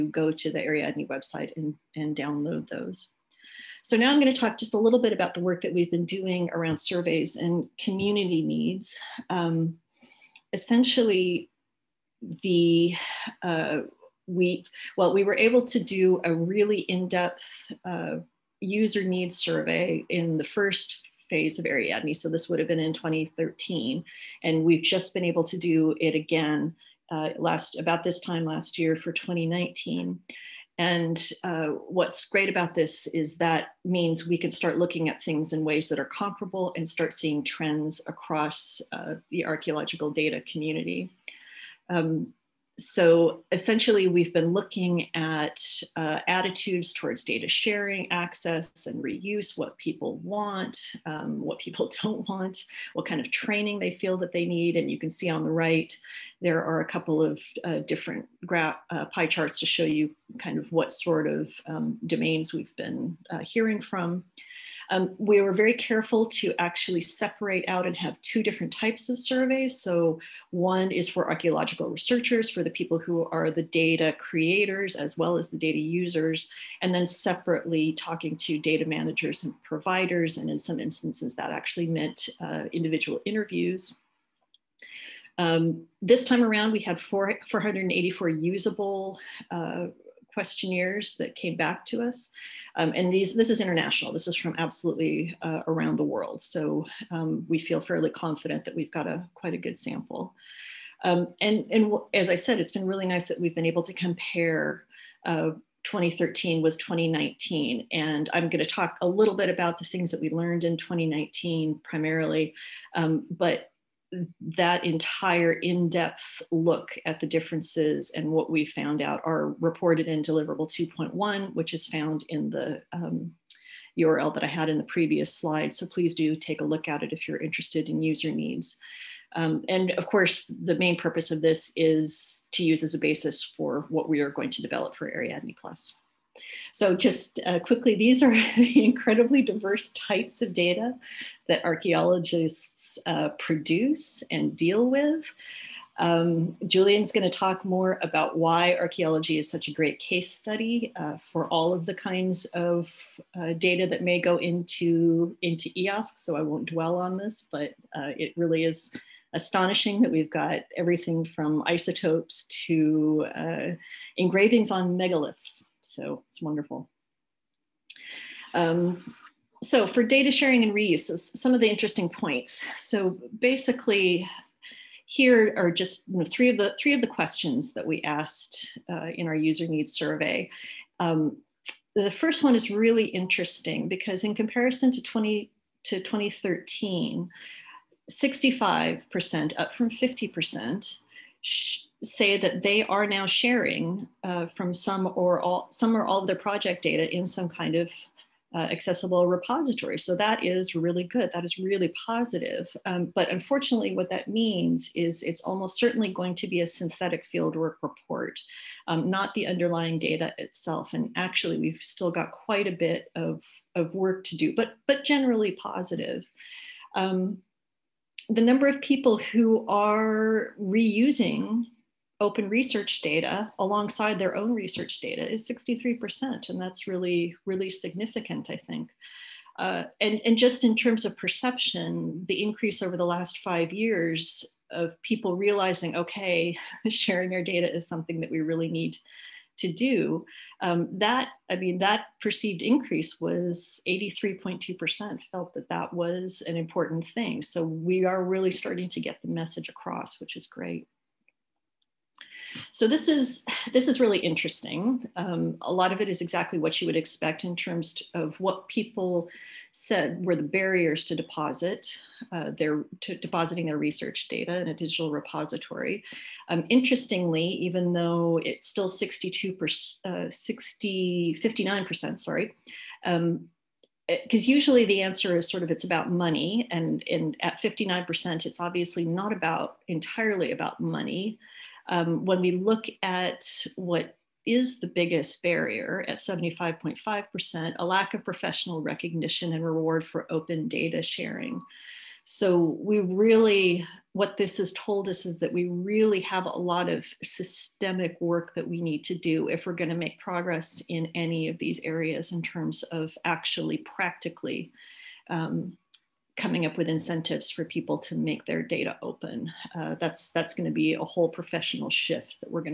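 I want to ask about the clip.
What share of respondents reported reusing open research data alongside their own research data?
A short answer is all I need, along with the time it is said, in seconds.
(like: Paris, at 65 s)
63%, at 225 s.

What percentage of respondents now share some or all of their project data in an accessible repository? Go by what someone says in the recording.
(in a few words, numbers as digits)
65%.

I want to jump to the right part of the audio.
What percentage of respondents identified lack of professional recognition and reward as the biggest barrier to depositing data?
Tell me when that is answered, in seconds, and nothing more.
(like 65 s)
286 s.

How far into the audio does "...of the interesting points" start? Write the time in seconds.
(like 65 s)
171 s.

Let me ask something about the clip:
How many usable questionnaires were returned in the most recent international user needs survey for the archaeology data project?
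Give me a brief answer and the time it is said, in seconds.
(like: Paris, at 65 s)
484, at 87 s.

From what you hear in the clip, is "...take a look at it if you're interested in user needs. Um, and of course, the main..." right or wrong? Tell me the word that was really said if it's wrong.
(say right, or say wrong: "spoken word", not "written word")
right.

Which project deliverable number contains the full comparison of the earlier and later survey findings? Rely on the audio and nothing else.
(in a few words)
2.1.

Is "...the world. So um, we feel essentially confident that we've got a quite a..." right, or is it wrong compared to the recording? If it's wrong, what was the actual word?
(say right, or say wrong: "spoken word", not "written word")
wrong: "fairly", not "essentially".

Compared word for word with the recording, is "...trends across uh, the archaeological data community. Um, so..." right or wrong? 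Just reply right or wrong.
right.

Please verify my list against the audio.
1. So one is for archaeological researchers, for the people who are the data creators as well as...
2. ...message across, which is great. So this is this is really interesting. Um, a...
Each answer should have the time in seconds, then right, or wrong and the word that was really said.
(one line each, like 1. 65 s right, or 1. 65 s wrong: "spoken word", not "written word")
1. 69 s right
2. 249 s right.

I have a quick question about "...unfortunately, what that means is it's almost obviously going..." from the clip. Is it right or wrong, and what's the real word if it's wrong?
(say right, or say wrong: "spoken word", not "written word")
wrong: "certainly", not "obviously".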